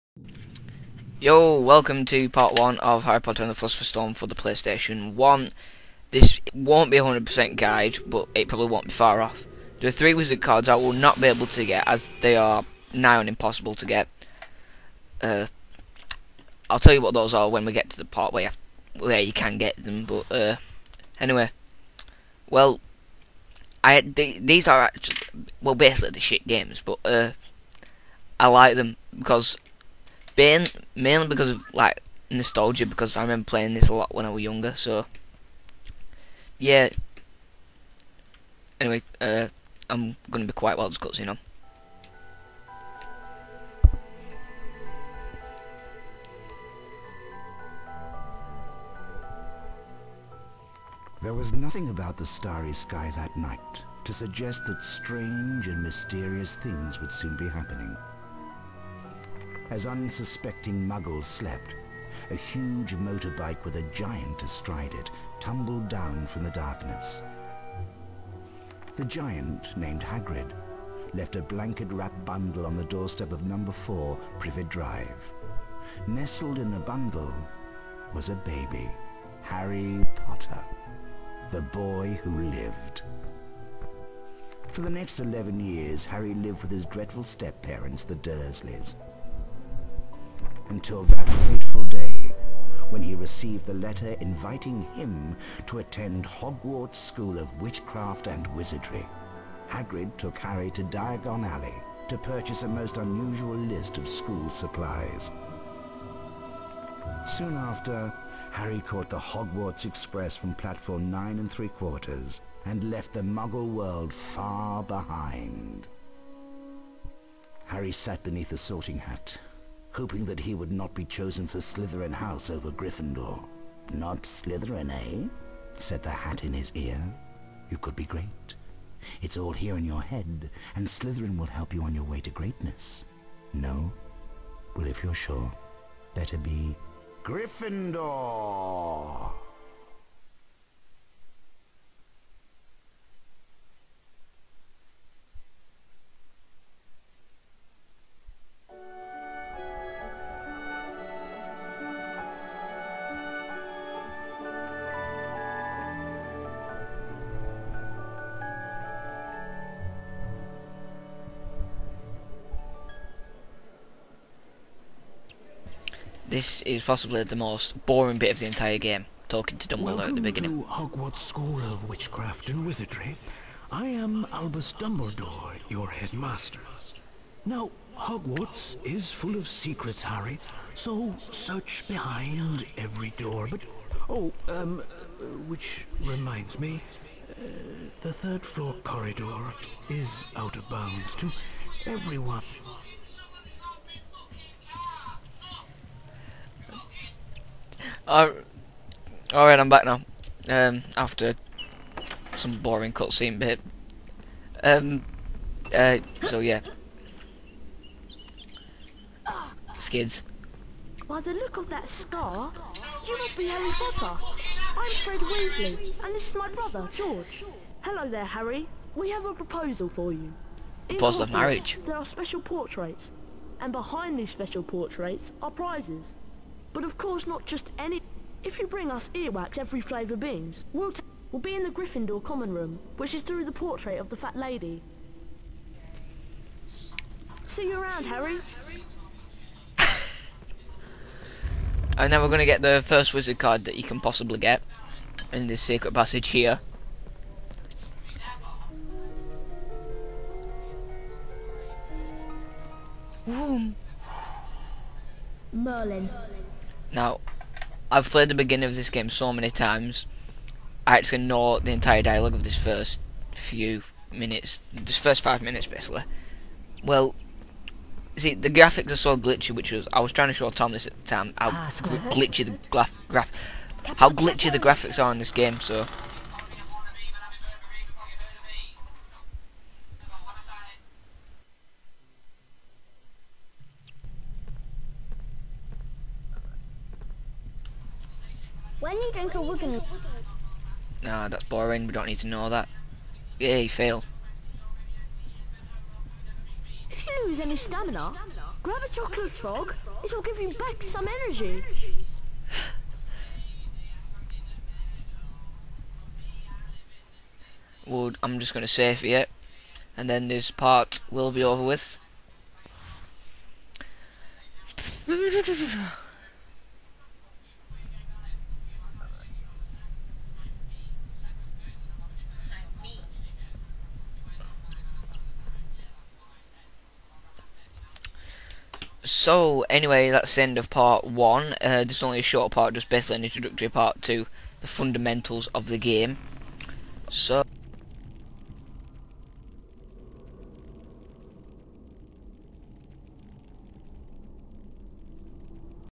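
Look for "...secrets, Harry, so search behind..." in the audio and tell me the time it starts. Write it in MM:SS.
02:59.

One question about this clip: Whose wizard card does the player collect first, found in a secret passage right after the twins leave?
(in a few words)
Merlin.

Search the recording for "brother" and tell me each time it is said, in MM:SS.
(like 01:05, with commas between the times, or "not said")
03:36.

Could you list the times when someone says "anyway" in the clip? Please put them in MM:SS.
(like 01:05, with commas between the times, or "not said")
00:21, 00:38, 05:29.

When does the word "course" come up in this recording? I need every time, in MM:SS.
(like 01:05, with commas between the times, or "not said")
03:46.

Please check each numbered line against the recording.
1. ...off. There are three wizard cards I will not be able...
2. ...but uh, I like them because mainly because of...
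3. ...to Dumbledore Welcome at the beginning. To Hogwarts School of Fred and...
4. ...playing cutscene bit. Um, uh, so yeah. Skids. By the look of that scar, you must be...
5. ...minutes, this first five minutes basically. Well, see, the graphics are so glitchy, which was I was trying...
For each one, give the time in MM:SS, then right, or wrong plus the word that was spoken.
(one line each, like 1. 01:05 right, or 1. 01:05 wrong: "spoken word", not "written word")
1. 00:09 right
2. 00:26 right
3. 02:49 wrong: "Witchcraft", not "Fred"
4. 03:22 wrong: "boring", not "playing"
5. 04:24 right.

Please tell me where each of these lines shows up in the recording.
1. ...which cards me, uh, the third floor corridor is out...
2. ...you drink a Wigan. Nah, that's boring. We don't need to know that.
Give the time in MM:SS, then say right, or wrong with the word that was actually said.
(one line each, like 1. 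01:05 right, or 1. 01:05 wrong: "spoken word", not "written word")
1. 03:05 wrong: "reminds", not "cards"
2. 04:49 right.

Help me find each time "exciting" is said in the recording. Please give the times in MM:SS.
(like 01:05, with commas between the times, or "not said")
not said.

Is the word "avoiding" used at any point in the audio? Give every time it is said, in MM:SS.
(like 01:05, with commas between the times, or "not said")
not said.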